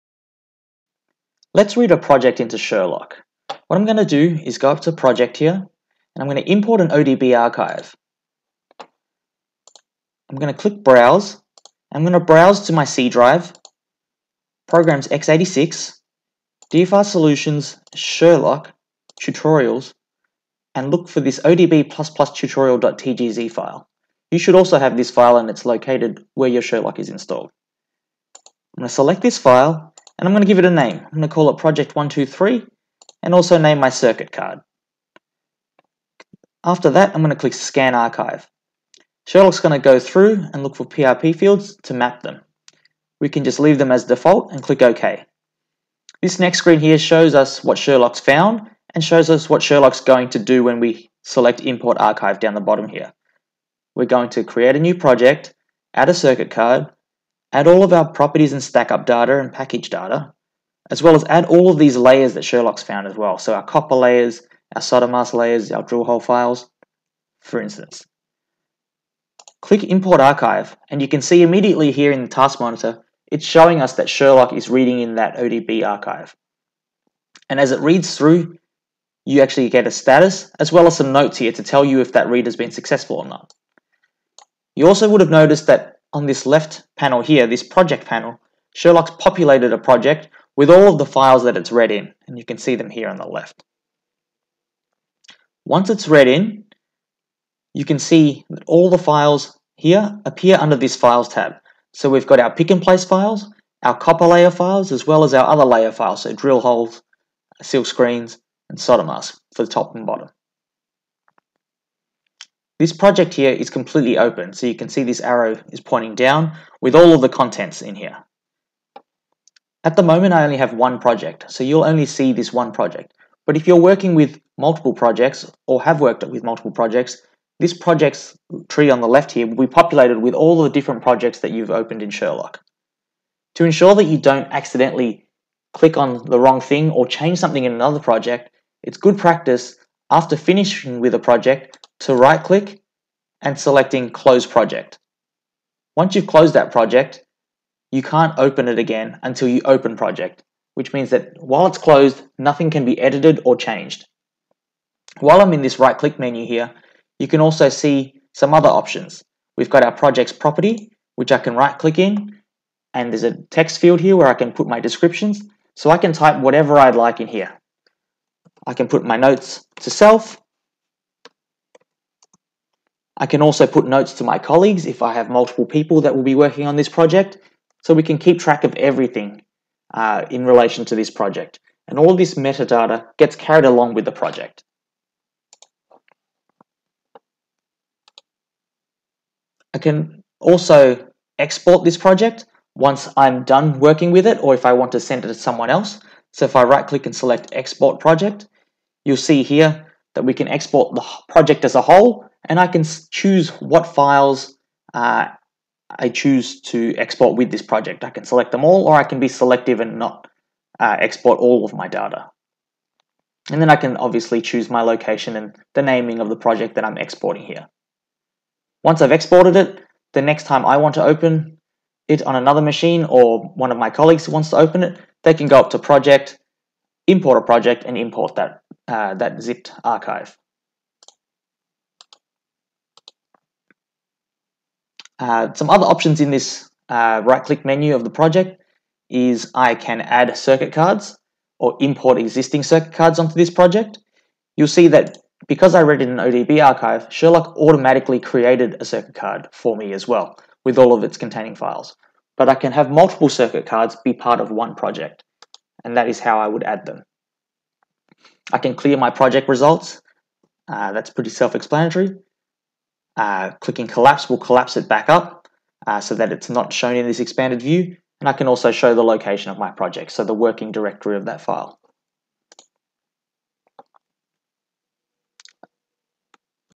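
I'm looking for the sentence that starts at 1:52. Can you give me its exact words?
This project here is completely open, so you can see this arrow is pointing down with all of the contents in here.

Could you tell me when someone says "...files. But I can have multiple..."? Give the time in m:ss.
4:11.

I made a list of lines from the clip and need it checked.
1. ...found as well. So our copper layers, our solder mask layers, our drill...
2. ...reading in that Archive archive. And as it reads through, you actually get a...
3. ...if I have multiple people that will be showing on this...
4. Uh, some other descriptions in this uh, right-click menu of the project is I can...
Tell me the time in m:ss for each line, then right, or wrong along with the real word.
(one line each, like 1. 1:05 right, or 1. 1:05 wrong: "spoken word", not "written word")
1. 1:02 right
2. 1:14 wrong: "ODB", not "Archive"
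3. 2:54 wrong: "working", not "showing"
4. 3:55 wrong: "options", not "descriptions".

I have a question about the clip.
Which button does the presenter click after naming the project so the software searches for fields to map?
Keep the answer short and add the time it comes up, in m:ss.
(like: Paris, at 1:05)
Scan Archive, at 0:37.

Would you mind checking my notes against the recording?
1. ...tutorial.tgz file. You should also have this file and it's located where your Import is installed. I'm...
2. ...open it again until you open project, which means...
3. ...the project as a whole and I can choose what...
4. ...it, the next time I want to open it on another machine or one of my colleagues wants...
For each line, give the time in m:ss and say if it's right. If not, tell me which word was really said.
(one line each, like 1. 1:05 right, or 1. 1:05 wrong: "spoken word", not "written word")
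1. 0:22 wrong: "Sherlock", not "Import"
2. 2:28 right
3. 3:20 right
4. 3:39 right.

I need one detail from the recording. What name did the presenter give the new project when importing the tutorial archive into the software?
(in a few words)
project123.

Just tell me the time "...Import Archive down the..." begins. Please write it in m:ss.
0:51.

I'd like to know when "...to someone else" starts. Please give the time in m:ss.
3:15.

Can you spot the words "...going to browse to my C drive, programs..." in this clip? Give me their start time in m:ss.
0:12.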